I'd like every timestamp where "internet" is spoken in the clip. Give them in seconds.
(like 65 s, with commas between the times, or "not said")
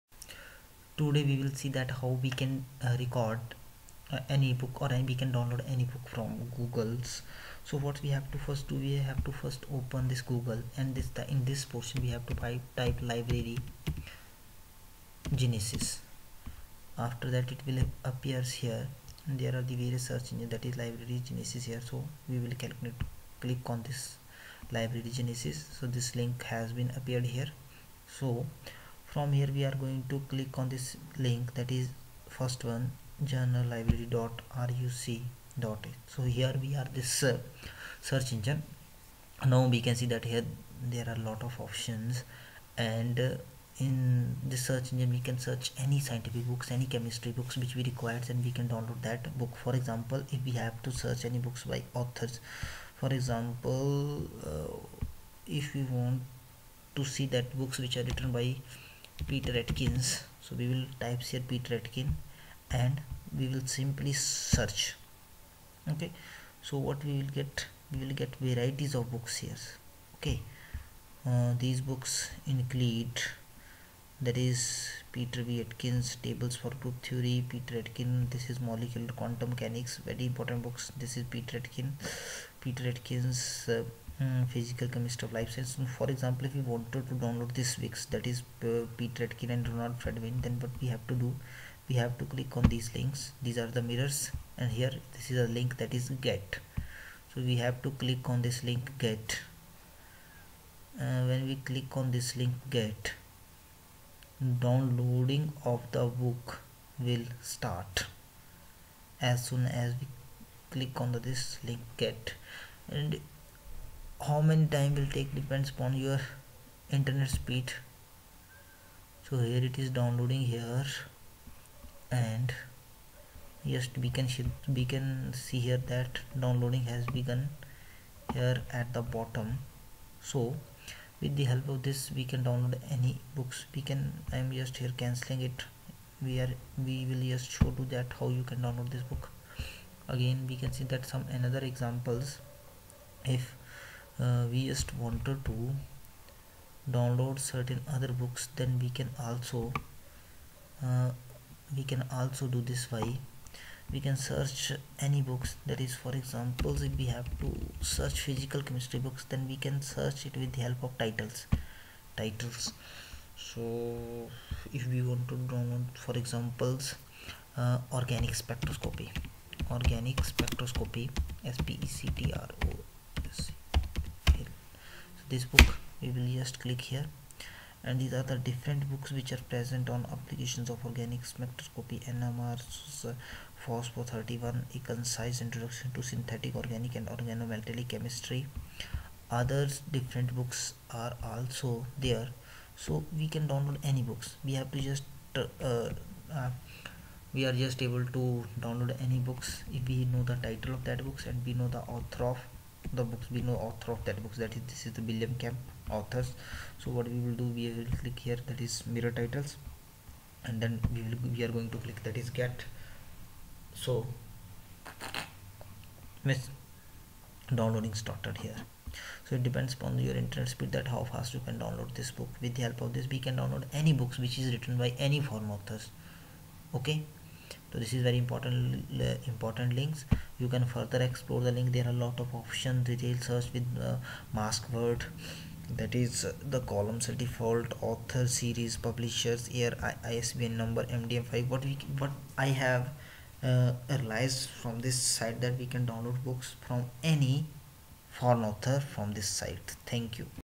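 116 s, 220 s.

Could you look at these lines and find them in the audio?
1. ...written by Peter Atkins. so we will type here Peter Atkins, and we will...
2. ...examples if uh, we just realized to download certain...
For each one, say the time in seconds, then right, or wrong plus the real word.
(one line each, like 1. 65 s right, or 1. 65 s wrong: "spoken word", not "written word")
1. 58 s right
2. 141 s wrong: "wanted", not "realized".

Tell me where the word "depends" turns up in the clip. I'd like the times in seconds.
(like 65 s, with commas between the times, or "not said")
115 s, 219 s.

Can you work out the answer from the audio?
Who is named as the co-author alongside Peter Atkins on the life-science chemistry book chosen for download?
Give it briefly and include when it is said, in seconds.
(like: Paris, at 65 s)
Ronald Friedman, at 89 s.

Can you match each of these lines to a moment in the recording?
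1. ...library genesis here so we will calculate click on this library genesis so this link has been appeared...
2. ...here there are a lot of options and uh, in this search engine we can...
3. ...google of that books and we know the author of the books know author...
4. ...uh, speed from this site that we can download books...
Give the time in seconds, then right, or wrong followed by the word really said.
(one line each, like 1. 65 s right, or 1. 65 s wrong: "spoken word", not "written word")
1. 20 s right
2. 40 s right
3. 200 s wrong: "title", not "google"
4. 243 s wrong: "realized", not "speed".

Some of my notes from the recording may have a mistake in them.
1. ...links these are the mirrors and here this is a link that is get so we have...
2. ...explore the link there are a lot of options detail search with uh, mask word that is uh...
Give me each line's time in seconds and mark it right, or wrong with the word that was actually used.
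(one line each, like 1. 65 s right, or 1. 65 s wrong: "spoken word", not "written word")
1. 92 s right
2. 231 s right.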